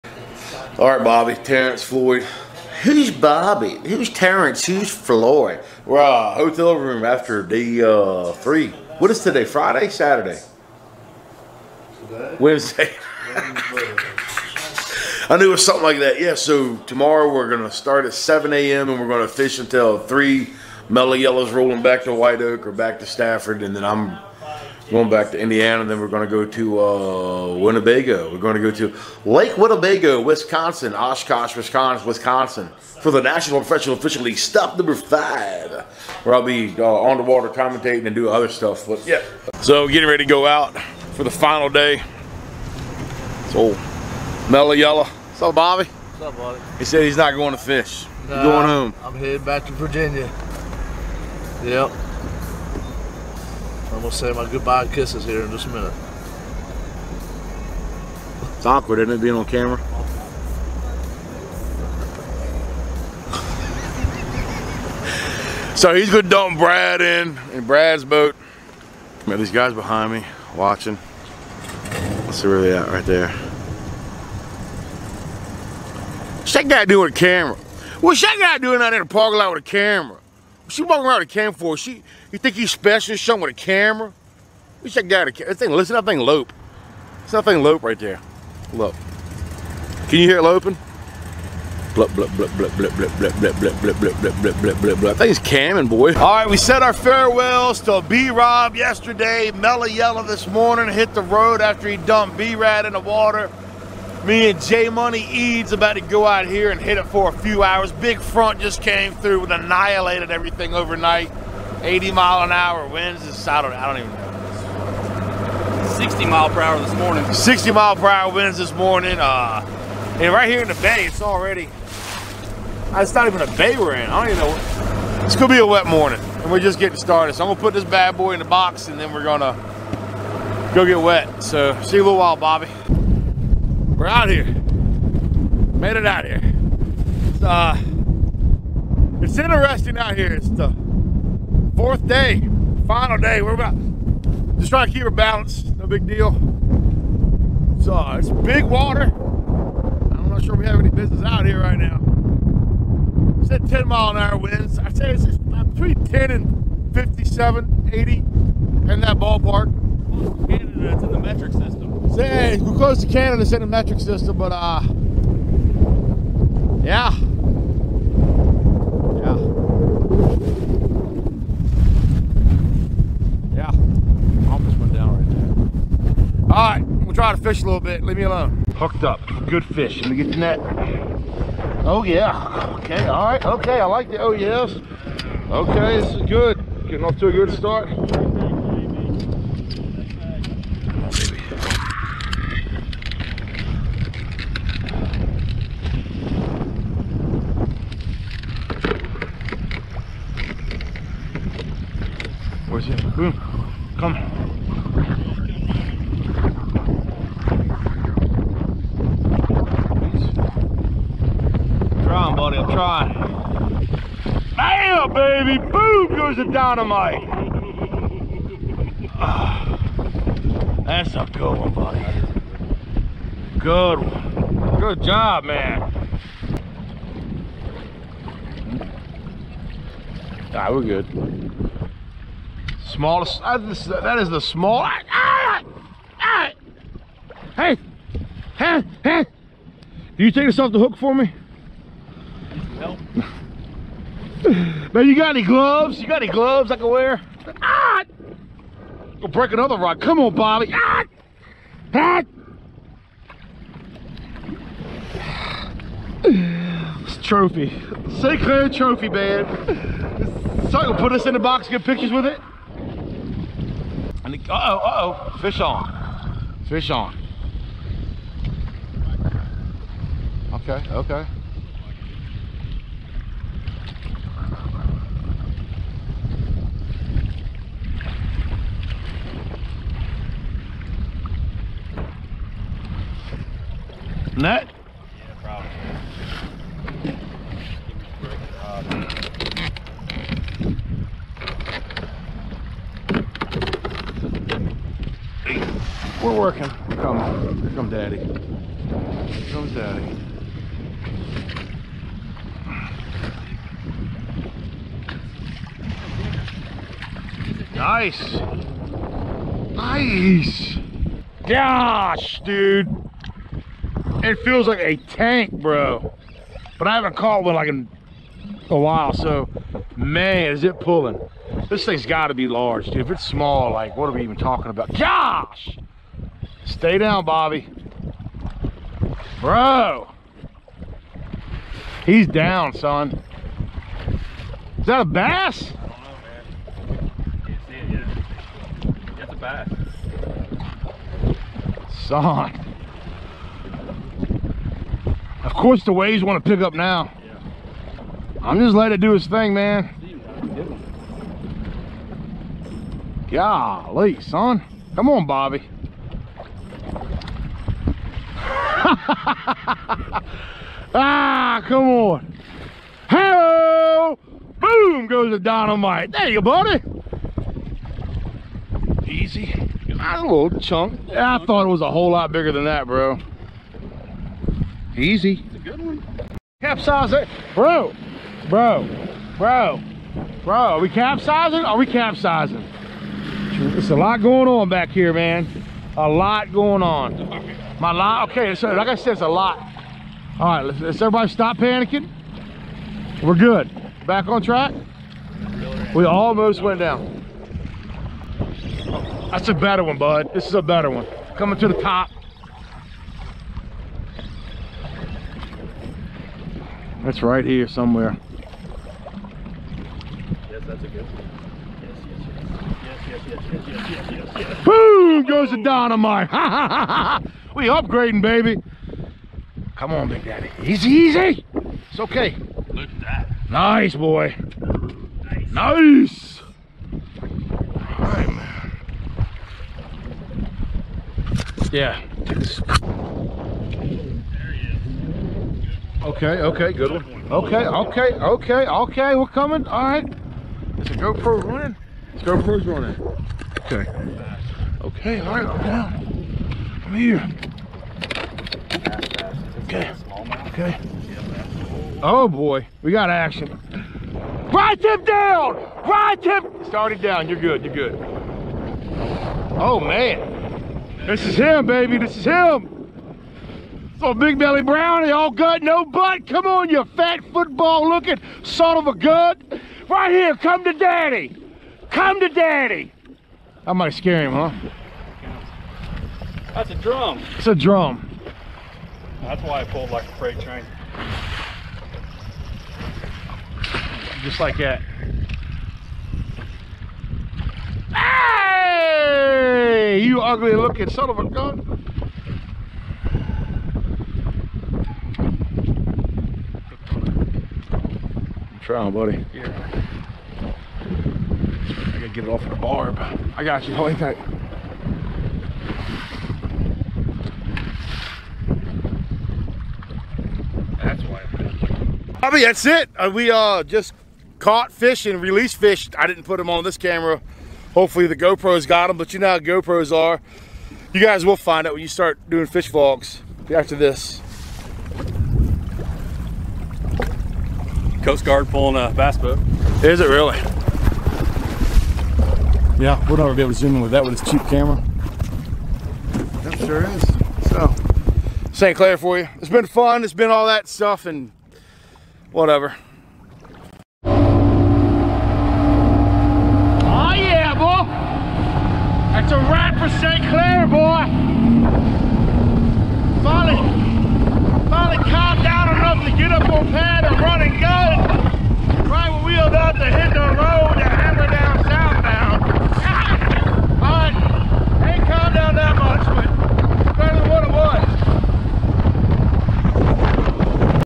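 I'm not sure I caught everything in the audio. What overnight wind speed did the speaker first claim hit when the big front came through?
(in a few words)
80 mph.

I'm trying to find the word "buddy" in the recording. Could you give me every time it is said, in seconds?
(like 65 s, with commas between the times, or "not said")
212 s, 221 s, 366 s, 498 s.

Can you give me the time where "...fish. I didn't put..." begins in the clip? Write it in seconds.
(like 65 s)
515 s.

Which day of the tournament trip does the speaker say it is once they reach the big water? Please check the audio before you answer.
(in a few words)
fourth day.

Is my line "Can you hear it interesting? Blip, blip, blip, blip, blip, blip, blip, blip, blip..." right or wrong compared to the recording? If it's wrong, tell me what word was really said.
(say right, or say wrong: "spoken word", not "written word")
wrong: "loping", not "interesting".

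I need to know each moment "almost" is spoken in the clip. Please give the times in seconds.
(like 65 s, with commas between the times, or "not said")
174 s, 396 s.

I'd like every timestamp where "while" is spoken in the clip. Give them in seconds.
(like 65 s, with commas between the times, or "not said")
132 s, 318 s.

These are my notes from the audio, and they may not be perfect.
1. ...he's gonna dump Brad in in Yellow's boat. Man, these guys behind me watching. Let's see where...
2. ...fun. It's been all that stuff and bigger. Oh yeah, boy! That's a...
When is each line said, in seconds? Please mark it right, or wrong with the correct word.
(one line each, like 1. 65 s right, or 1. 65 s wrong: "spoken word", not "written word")
1. 65 s wrong: "Brad", not "Yellow"
2. 539 s wrong: "whatever", not "bigger".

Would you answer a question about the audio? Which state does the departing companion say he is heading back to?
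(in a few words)
Virginia.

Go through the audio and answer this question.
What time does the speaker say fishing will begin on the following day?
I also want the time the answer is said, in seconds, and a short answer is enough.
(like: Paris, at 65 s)
7 a.m., at 18 s.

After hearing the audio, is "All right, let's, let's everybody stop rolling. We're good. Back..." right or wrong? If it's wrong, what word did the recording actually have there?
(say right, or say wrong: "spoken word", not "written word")
wrong: "panicking", not "rolling".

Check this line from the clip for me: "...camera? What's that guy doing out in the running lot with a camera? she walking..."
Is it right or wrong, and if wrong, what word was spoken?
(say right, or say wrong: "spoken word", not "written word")
wrong: "parking", not "running".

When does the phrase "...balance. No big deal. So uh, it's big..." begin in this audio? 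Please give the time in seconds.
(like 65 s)
145 s.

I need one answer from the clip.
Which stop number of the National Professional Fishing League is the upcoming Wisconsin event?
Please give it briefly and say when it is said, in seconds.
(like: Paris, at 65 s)
5, at 34 s.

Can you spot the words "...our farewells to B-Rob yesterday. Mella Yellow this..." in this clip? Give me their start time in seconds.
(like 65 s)
96 s.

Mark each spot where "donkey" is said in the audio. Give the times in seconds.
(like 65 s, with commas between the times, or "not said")
not said.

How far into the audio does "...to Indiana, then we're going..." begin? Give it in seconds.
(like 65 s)
25 s.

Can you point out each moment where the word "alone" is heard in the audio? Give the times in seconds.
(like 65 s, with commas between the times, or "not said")
178 s.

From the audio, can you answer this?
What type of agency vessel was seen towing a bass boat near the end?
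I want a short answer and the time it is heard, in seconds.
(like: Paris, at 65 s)
Coast Guard, at 528 s.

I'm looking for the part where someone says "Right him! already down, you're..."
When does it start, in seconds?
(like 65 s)
455 s.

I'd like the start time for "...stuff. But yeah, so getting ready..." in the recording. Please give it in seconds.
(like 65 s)
38 s.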